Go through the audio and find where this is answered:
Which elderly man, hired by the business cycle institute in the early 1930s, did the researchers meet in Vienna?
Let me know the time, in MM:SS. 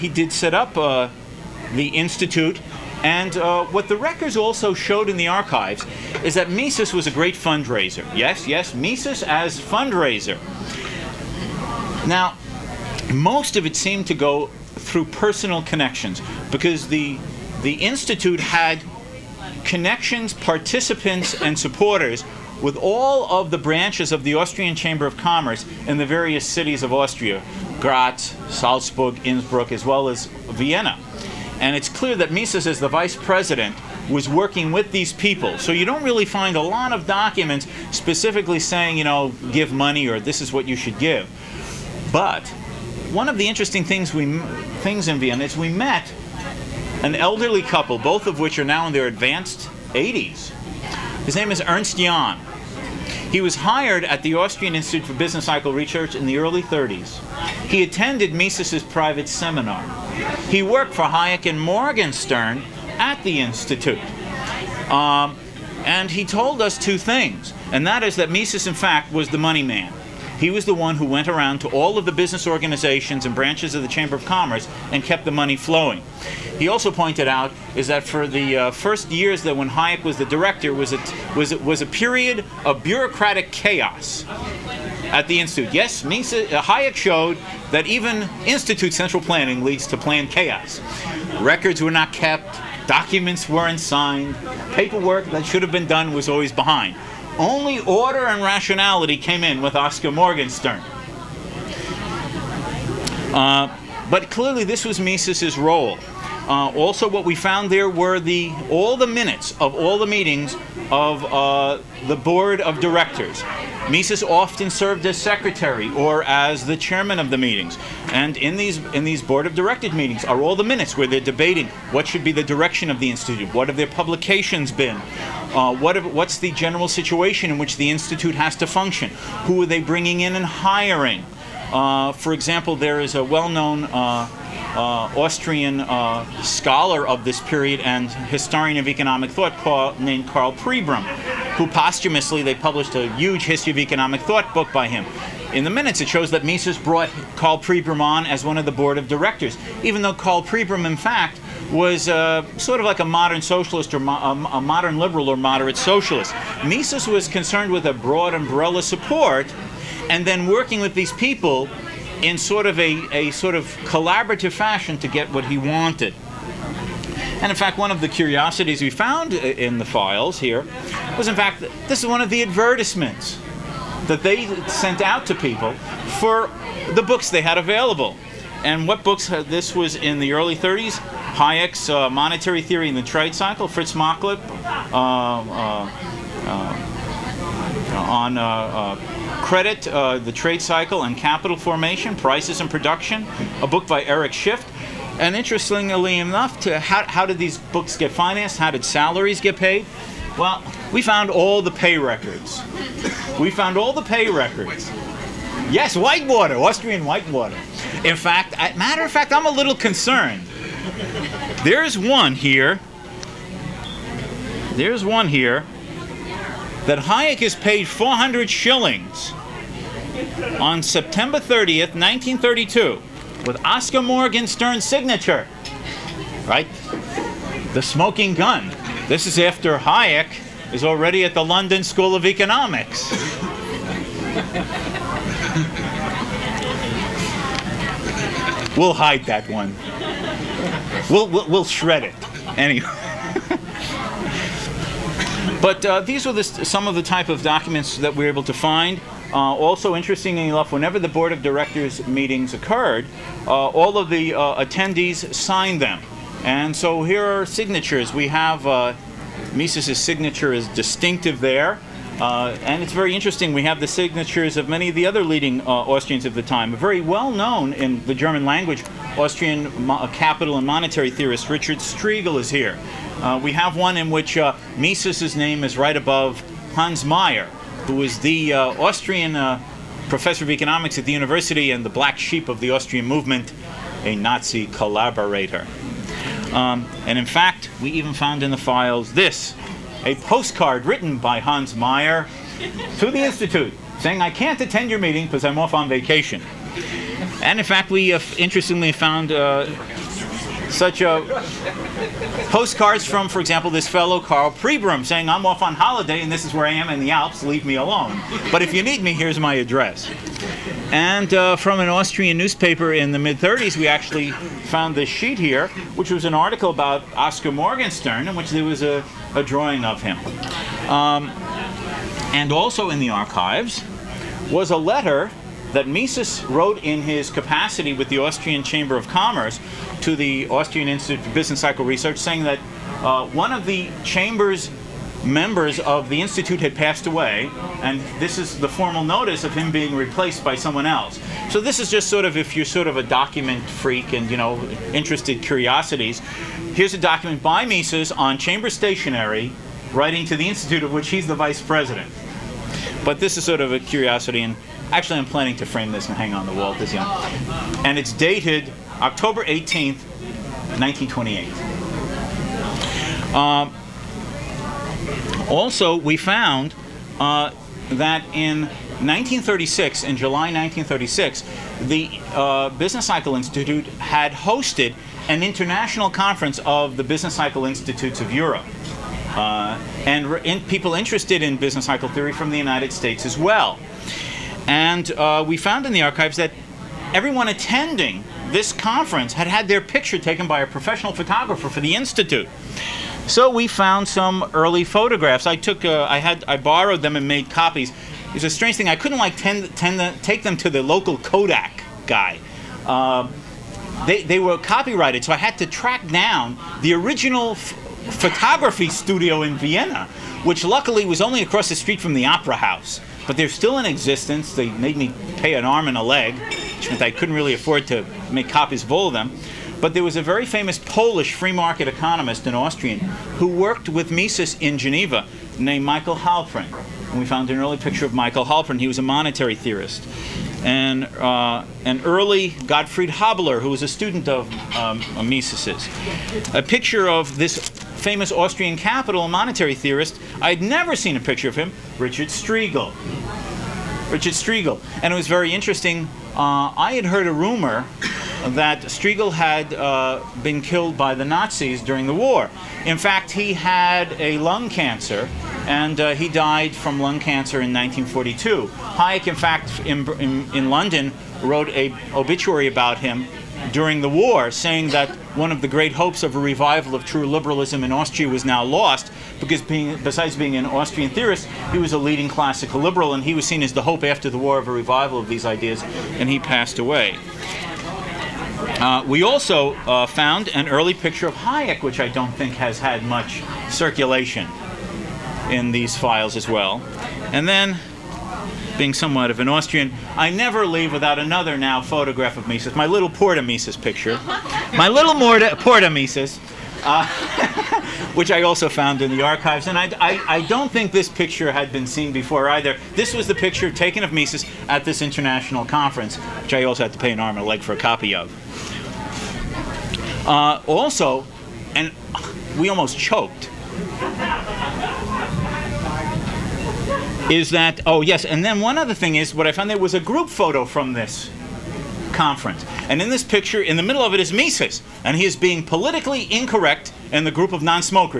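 00:51.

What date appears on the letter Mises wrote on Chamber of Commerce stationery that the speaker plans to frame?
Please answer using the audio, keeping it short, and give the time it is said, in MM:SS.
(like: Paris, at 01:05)
October 18, 1928, at 05:58.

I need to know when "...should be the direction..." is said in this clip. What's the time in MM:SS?
02:02.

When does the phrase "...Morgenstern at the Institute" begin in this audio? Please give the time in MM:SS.
01:01.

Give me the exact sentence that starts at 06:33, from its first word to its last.
So we found some early photographs.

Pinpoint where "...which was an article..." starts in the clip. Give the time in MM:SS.
05:15.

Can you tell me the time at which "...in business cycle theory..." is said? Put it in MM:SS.
06:21.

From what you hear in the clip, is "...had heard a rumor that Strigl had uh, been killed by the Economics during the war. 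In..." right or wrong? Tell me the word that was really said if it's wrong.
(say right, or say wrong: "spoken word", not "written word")
wrong: "Nazis", not "Economics".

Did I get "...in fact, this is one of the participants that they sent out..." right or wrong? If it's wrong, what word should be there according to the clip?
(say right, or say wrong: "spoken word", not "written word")
wrong: "advertisements", not "participants".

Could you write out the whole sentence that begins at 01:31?
Records were not kept, documents weren't signed, paperwork that should have been done was always behind.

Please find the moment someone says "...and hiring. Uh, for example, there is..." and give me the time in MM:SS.
02:10.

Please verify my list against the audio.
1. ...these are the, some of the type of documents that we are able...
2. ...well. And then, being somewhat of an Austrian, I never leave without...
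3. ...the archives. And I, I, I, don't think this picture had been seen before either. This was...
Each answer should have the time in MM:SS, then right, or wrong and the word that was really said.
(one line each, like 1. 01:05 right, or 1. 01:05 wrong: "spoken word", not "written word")
1. 04:05 right
2. 08:06 right
3. 08:19 right.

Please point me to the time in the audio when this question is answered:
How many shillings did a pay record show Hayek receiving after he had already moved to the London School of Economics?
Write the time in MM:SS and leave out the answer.
03:37.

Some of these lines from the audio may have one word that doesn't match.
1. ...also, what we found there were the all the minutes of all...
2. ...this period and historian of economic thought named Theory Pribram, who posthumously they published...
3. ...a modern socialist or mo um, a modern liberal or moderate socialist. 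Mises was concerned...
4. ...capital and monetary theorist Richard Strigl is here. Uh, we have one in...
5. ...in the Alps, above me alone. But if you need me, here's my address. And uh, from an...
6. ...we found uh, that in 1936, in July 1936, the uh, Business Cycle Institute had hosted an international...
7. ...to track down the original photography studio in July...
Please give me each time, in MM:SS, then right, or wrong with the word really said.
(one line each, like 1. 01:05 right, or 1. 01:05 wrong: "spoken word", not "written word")
1. 01:46 right
2. 02:17 wrong: "Karl", not "Theory"
3. 02:32 right
4. 04:30 right
5. 05:06 wrong: "leave", not "above"
6. 06:05 right
7. 06:45 wrong: "Vienna", not "July".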